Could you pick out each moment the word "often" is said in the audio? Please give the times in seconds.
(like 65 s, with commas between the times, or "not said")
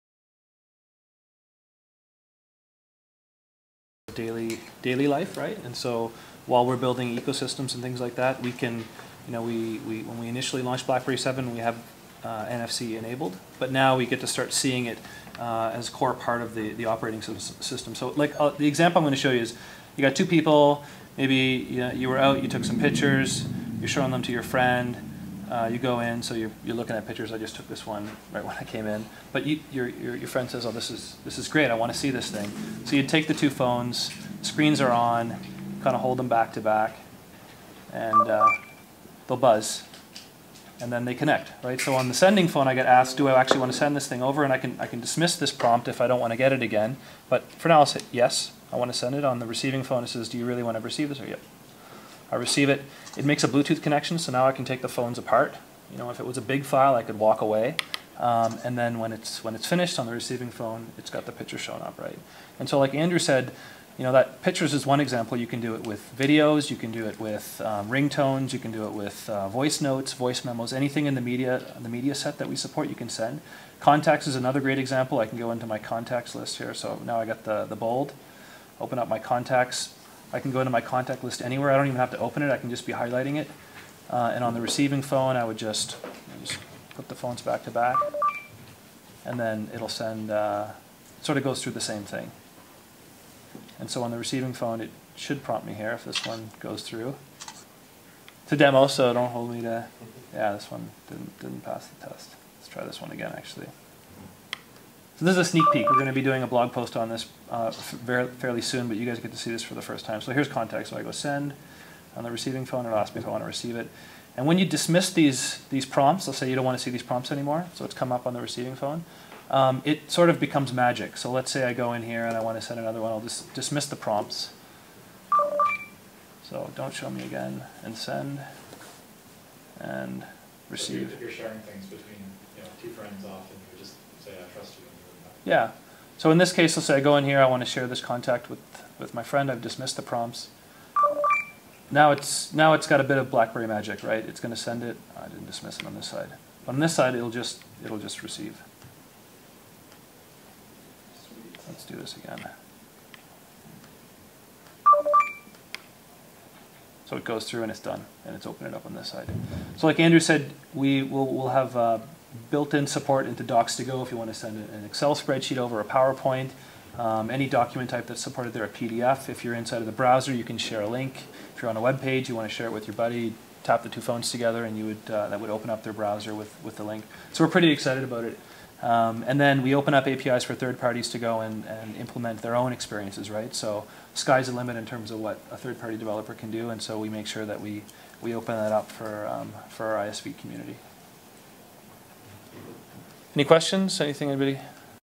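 133 s.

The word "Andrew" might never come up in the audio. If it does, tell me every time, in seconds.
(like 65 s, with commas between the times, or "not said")
62 s, 159 s.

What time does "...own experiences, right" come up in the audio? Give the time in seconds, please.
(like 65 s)
182 s.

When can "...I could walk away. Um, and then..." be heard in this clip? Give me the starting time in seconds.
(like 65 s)
56 s.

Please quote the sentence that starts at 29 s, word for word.
But you, your, your, your friend says, oh, this is, this is great.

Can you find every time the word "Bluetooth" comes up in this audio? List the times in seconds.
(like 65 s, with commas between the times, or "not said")
53 s.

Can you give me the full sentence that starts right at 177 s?
So we're pretty excited about it.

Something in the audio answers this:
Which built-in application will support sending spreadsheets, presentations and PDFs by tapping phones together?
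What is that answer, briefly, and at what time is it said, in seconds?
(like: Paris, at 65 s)
Docs to Go, at 163 s.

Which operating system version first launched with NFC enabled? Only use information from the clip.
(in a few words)
BlackBerry 7.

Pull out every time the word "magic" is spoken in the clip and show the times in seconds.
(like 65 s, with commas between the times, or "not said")
120 s, 143 s.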